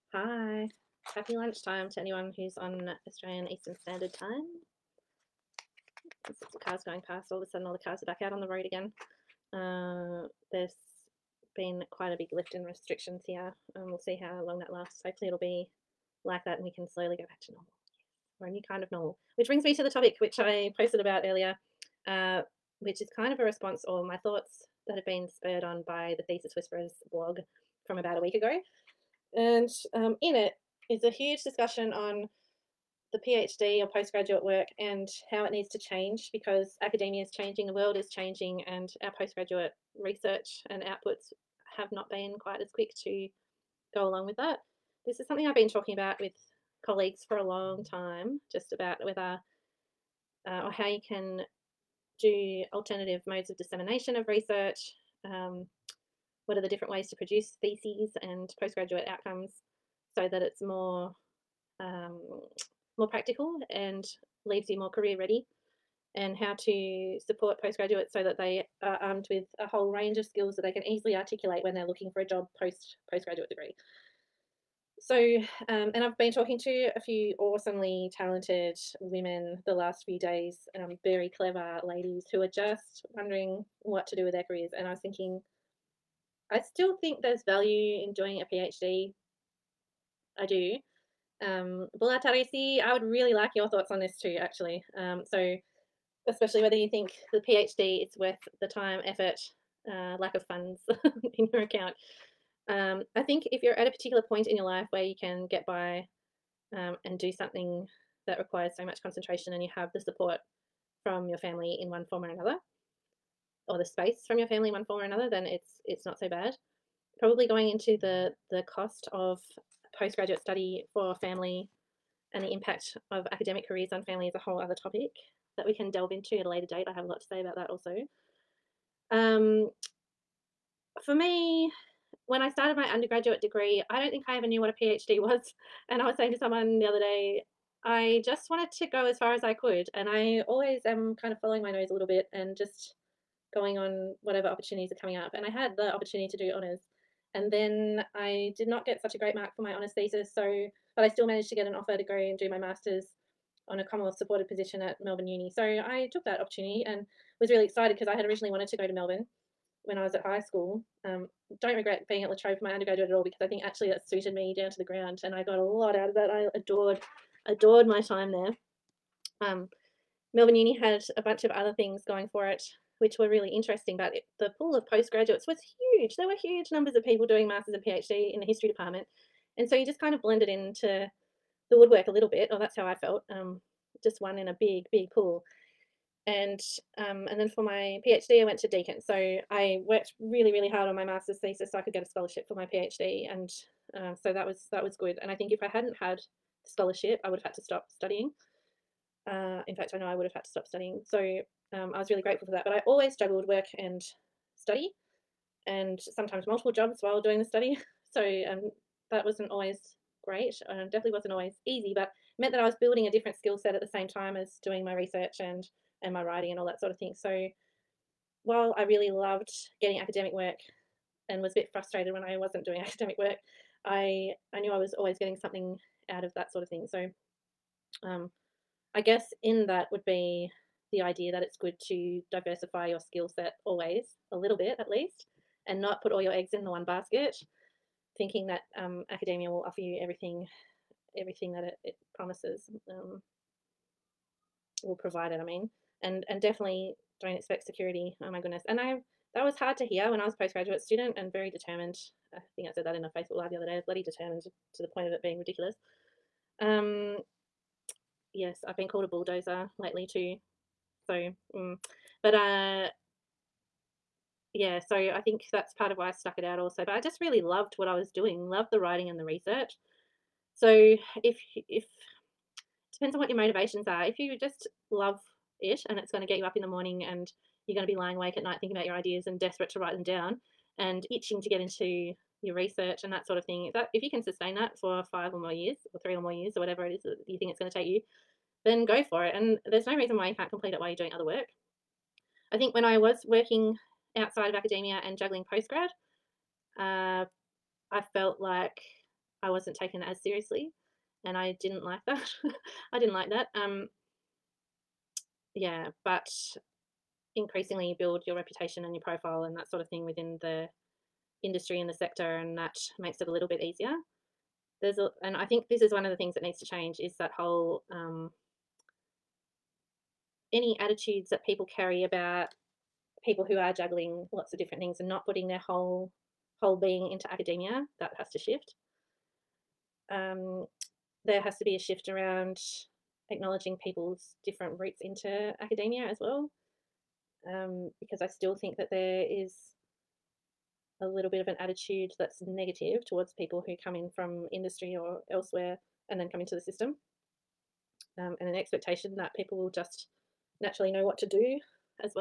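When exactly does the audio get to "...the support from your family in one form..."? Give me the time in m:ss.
1:49.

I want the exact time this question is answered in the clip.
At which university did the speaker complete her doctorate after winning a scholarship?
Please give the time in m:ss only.
3:08.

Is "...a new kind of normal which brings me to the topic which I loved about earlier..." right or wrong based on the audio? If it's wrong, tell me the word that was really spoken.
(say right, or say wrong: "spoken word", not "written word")
wrong: "posted", not "loved".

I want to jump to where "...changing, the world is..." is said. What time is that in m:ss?
0:37.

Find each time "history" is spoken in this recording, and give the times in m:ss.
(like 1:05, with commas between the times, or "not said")
2:58.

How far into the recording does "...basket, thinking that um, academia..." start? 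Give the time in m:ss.
3:56.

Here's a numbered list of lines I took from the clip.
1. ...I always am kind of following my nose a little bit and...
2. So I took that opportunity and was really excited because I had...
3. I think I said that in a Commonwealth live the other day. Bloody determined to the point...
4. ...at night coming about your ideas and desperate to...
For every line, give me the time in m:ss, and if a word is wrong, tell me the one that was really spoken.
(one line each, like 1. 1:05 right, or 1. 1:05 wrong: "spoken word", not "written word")
1. 2:20 right
2. 2:35 right
3. 4:12 wrong: "Facebook", not "Commonwealth"
4. 4:38 wrong: "thinking", not "coming".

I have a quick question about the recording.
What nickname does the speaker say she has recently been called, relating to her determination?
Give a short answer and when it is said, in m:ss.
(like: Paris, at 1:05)
bulldozer, at 4:19.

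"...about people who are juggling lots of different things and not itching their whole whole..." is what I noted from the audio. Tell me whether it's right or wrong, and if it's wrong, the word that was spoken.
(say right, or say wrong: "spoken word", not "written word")
wrong: "putting", not "itching".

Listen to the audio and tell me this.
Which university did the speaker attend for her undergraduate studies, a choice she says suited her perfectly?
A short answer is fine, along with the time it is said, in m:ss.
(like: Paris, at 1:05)
La Trobe, at 2:42.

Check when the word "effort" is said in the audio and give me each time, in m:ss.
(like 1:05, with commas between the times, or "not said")
1:39.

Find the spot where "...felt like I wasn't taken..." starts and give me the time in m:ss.
4:58.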